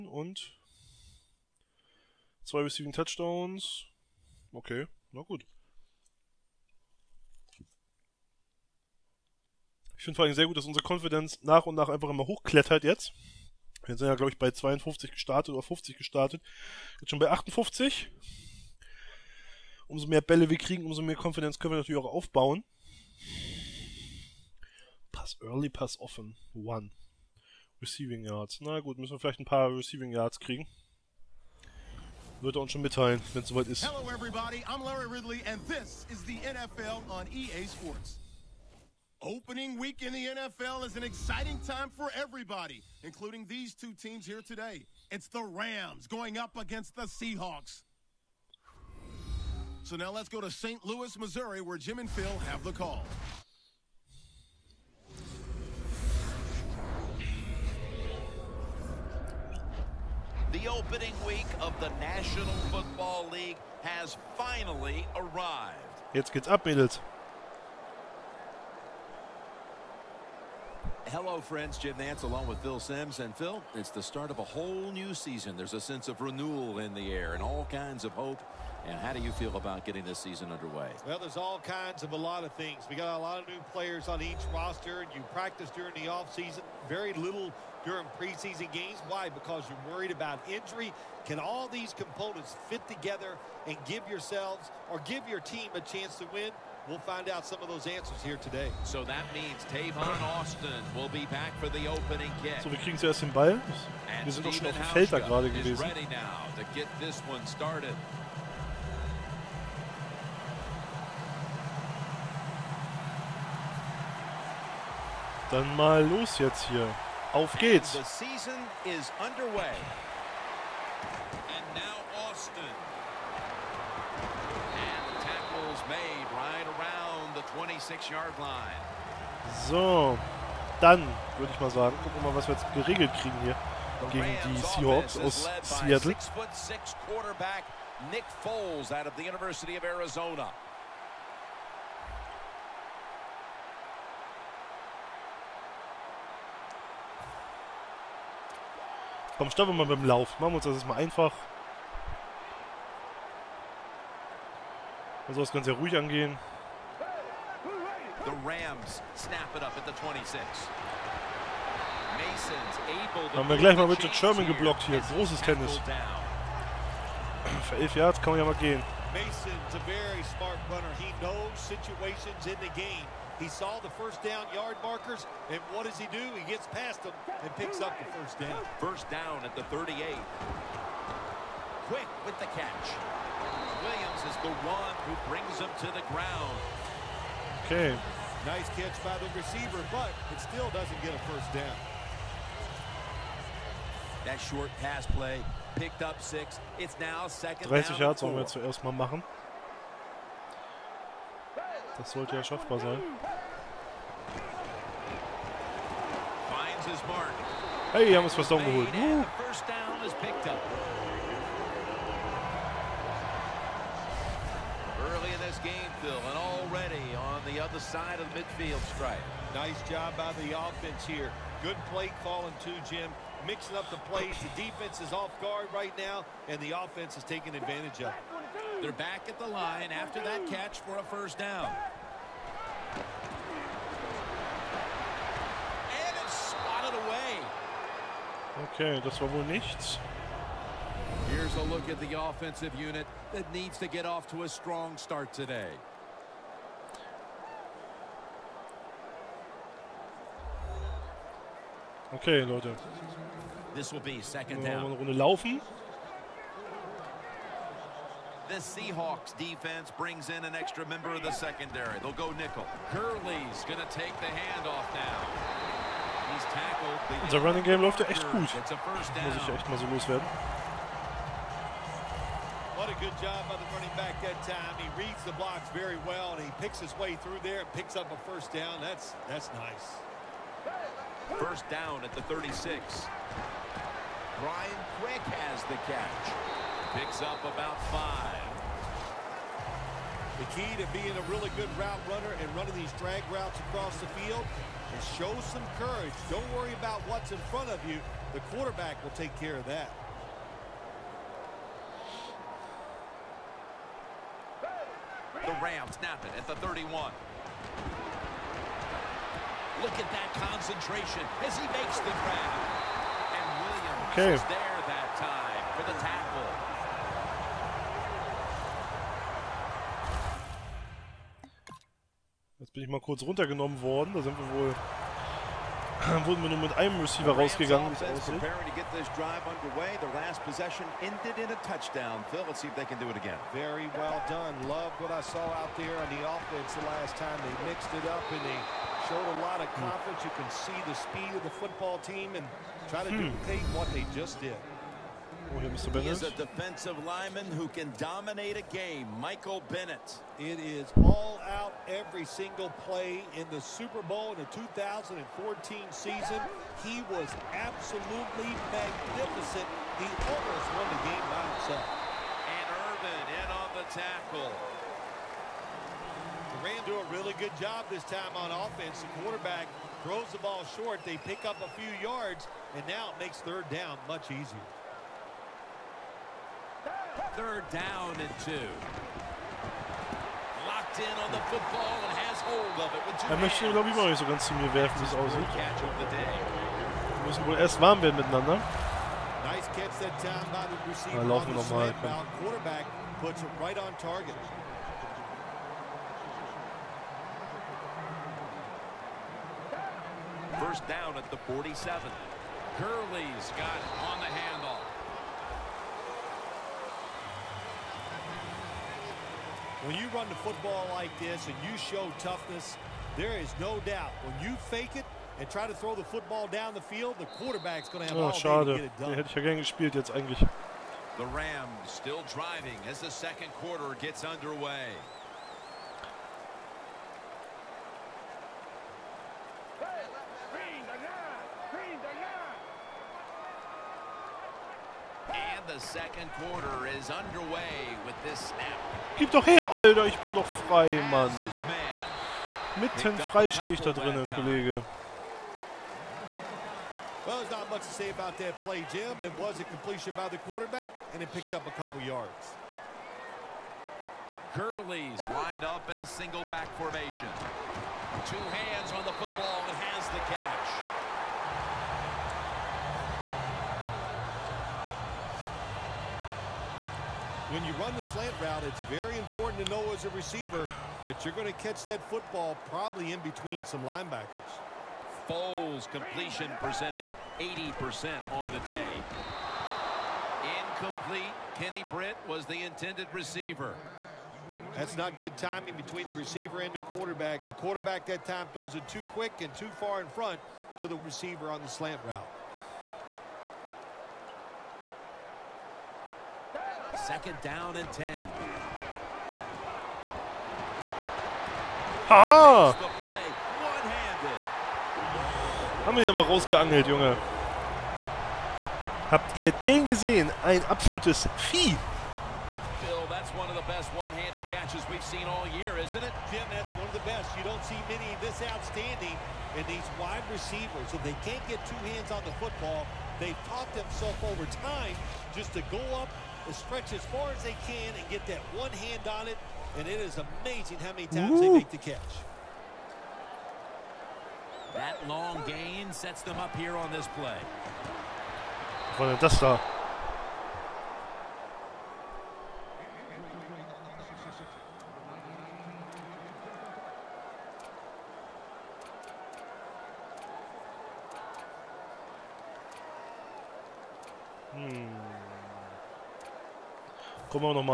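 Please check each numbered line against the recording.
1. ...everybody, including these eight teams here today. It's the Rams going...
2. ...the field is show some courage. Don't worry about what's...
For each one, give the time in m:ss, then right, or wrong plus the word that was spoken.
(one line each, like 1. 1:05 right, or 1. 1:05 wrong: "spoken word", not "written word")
1. 0:42 wrong: "two", not "eight"
2. 4:53 right.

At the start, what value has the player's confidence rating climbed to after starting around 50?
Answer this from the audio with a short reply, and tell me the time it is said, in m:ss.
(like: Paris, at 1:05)
58, at 0:17.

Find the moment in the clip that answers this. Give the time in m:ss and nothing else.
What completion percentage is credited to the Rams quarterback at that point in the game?
7:57.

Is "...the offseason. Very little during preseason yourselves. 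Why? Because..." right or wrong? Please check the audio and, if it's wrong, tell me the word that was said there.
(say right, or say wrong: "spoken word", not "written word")
wrong: "games", not "yourselves".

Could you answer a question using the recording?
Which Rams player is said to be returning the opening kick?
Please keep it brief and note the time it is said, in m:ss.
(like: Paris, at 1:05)
Tavon Austin, at 1:39.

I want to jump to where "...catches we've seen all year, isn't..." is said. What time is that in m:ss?
8:34.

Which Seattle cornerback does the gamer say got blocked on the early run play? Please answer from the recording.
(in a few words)
Richard Sherman.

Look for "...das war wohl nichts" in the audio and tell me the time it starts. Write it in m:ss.
3:59.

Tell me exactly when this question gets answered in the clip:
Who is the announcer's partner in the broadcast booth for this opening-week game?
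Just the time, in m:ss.
1:12.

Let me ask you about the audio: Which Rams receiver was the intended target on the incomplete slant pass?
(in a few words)
Kenny Britt.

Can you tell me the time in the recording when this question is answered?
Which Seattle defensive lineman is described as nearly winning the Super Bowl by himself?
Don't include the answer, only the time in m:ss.
5:49.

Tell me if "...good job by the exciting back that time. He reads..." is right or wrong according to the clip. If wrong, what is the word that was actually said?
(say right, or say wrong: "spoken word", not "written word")
wrong: "running", not "exciting".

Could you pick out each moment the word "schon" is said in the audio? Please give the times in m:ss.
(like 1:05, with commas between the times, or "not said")
0:17, 0:32, 1:44.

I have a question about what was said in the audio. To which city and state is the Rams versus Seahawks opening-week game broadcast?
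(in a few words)
St. Louis, Missouri.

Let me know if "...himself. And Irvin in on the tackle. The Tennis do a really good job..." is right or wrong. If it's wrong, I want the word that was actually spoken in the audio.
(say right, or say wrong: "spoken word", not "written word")
wrong: "Rams", not "Tennis".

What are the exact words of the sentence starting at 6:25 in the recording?
Wir müssen wohl erst warm werden miteinander.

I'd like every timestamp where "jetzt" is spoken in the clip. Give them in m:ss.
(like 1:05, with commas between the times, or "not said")
0:12, 0:16, 1:06, 1:56, 2:12, 2:30, 6:59.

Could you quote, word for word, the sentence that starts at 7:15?
And the second quarter is underway with this snap.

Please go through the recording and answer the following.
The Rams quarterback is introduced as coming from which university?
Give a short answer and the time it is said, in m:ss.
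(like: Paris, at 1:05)
University of Arizona, at 2:19.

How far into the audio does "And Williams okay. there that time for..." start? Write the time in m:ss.
5:13.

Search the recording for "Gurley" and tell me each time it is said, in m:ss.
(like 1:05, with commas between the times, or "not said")
4:22, 6:42, 7:34.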